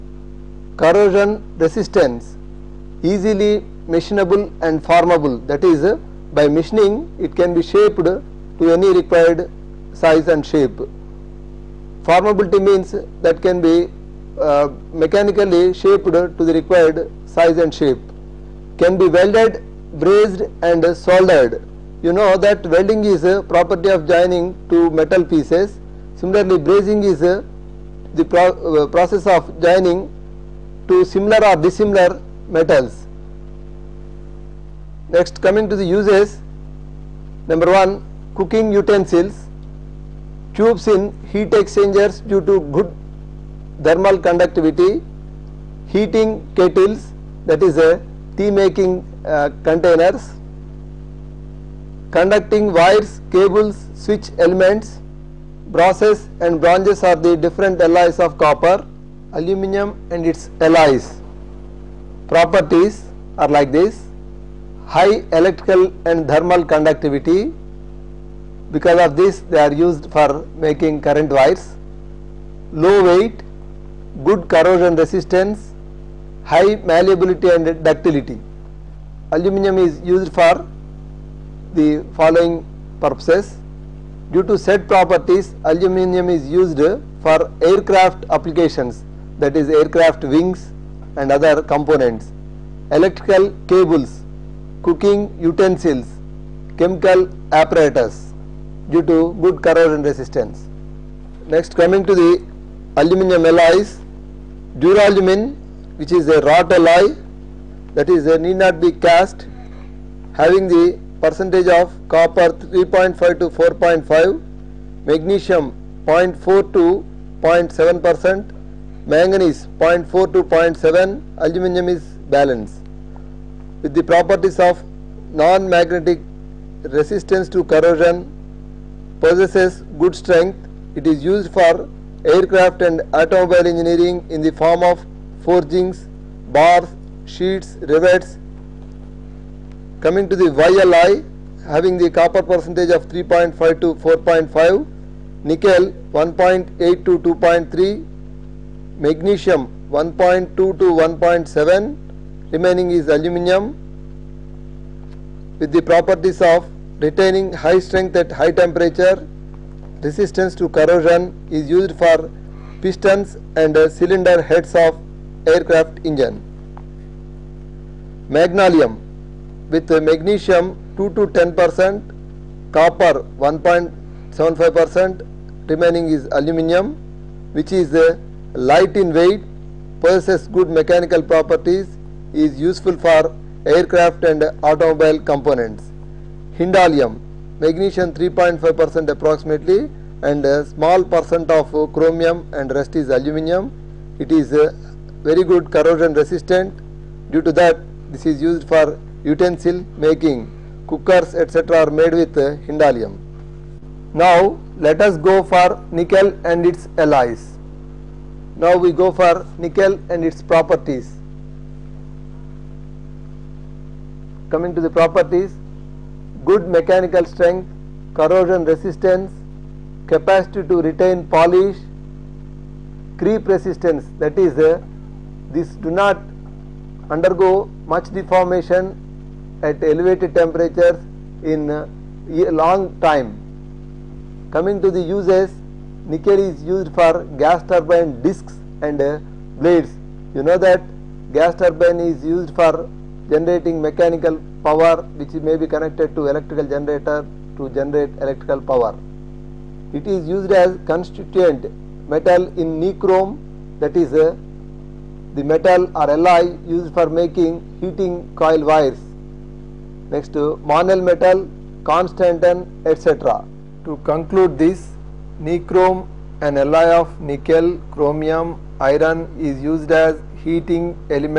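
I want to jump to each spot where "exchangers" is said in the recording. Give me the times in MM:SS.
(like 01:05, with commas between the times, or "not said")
00:41.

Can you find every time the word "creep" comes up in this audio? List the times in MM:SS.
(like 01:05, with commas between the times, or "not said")
03:43.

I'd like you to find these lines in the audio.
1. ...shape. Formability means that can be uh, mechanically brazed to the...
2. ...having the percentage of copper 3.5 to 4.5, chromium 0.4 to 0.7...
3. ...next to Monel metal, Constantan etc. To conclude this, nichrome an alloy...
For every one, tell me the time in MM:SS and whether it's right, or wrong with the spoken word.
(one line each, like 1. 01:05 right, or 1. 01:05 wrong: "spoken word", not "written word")
1. 00:10 wrong: "shaped", not "brazed"
2. 01:50 wrong: "magnesium", not "chromium"
3. 04:20 right.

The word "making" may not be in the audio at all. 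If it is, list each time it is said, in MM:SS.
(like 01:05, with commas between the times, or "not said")
00:48, 01:10, 03:19, 04:17.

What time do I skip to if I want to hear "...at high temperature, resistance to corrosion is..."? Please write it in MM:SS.
02:38.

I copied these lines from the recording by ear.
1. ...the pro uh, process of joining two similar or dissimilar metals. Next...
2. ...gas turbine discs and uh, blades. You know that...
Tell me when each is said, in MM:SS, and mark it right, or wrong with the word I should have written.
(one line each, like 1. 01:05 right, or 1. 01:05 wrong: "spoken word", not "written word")
1. 00:28 right
2. 03:57 right.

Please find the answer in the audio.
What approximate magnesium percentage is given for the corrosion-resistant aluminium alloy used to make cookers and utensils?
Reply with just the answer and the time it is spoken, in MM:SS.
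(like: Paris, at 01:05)
3.5 percent, at 03:08.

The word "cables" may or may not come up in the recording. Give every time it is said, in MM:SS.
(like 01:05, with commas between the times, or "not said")
00:53, 01:33.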